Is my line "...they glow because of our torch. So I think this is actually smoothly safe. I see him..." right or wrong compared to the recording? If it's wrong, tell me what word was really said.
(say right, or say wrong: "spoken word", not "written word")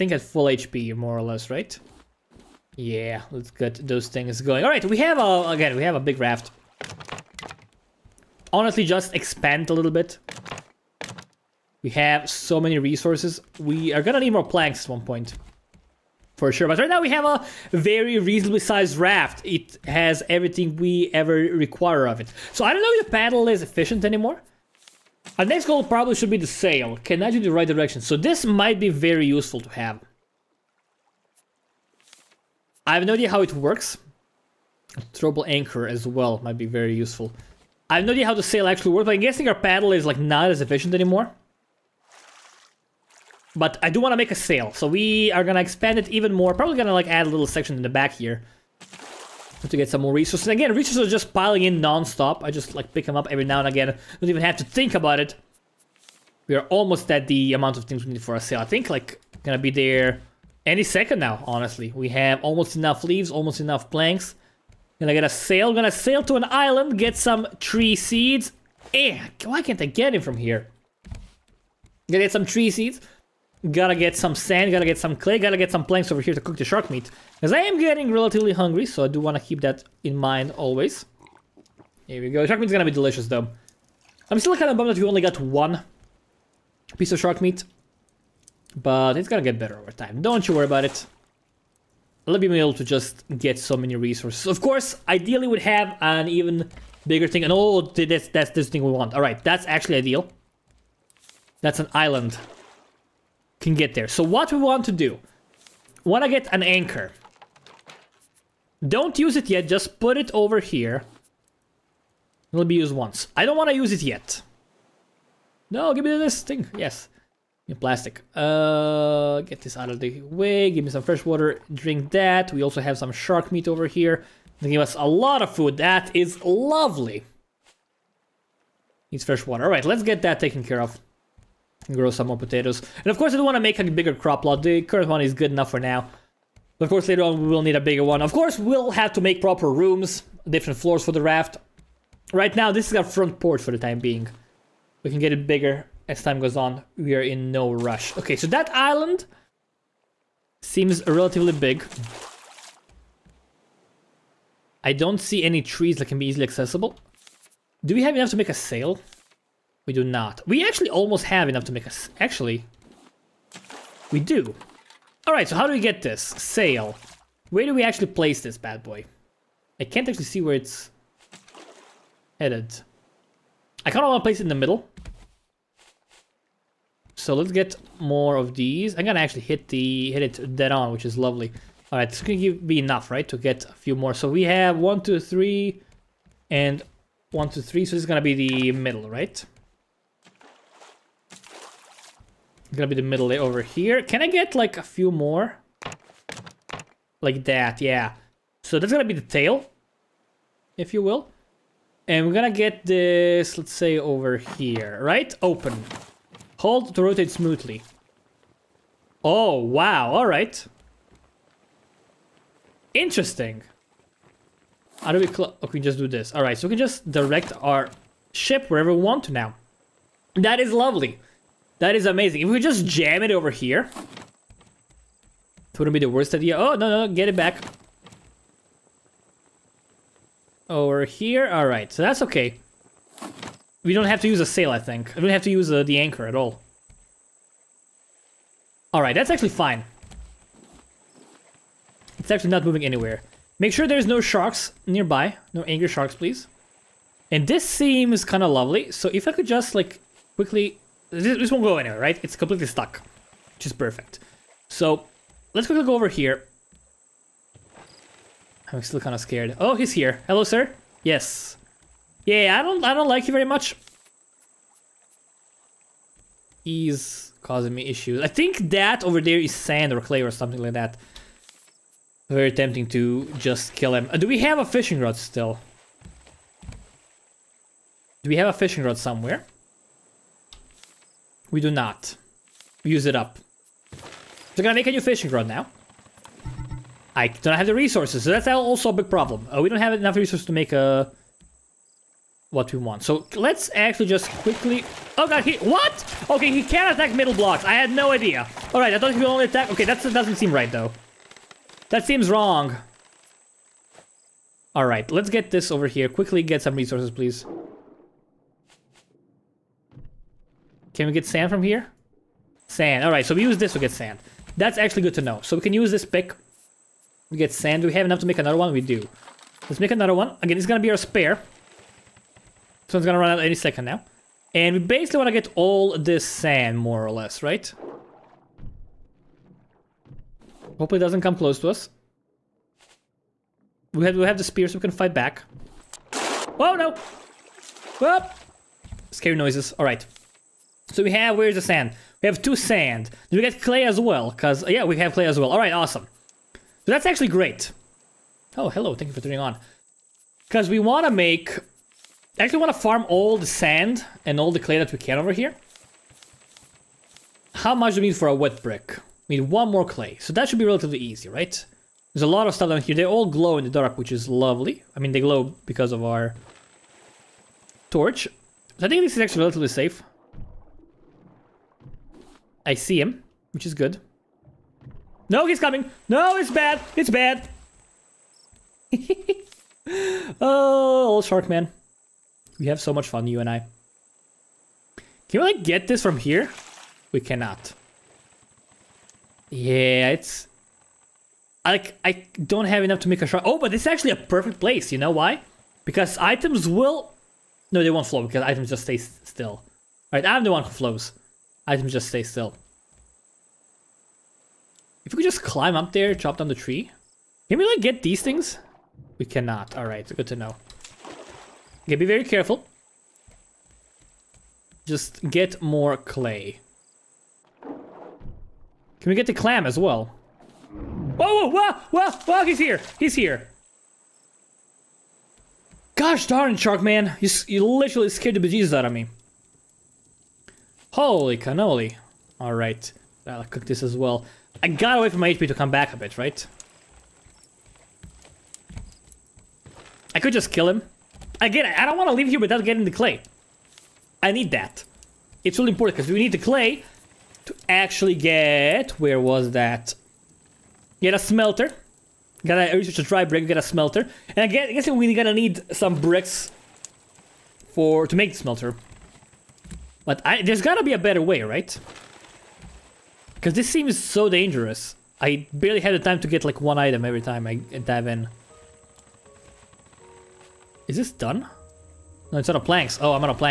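wrong: "relatively", not "smoothly".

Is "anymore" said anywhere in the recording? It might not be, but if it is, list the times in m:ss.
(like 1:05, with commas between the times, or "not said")
0:24, 0:40.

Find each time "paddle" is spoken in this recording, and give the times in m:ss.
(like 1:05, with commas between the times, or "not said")
0:23, 0:39.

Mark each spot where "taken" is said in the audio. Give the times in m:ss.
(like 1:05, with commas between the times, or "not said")
2:10.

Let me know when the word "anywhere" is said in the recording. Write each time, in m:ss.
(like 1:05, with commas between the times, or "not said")
4:02, 4:11.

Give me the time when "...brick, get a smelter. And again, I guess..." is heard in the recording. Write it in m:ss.
7:33.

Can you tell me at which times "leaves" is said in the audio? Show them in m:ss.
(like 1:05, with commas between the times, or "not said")
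1:03, 7:22.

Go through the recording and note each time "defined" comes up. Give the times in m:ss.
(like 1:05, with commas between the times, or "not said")
not said.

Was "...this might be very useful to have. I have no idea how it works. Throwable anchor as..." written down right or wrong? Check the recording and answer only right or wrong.
right.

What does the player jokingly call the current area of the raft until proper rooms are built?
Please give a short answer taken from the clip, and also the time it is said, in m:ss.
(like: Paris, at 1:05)
Front porch, at 2:23.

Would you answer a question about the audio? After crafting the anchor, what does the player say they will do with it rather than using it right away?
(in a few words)
Put it over here.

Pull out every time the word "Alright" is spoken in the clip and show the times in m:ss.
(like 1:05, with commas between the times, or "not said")
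4:58, 5:04.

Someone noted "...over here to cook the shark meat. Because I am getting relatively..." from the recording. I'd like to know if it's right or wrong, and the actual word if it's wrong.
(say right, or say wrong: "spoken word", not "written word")
right.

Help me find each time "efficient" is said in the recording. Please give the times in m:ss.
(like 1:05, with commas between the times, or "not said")
0:23, 0:40.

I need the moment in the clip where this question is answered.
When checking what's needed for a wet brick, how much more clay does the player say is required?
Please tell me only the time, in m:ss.
5:59.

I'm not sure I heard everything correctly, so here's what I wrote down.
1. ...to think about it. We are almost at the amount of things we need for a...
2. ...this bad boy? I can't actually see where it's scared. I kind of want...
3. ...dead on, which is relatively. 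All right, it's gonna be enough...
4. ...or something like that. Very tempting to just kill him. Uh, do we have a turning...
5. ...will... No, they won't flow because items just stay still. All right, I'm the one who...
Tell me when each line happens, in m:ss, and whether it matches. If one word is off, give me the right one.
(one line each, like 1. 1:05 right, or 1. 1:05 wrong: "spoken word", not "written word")
1. 0:54 right
2. 2:48 wrong: "headed", not "scared"
3. 3:00 wrong: "lovely", not "relatively"
4. 4:30 wrong: "fishing", not "turning"
5. 6:36 right.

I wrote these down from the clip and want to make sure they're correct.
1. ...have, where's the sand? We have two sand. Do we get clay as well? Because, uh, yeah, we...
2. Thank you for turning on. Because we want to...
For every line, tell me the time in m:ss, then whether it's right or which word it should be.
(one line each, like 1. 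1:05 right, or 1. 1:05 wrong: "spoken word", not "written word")
1. 5:41 right
2. 5:48 right.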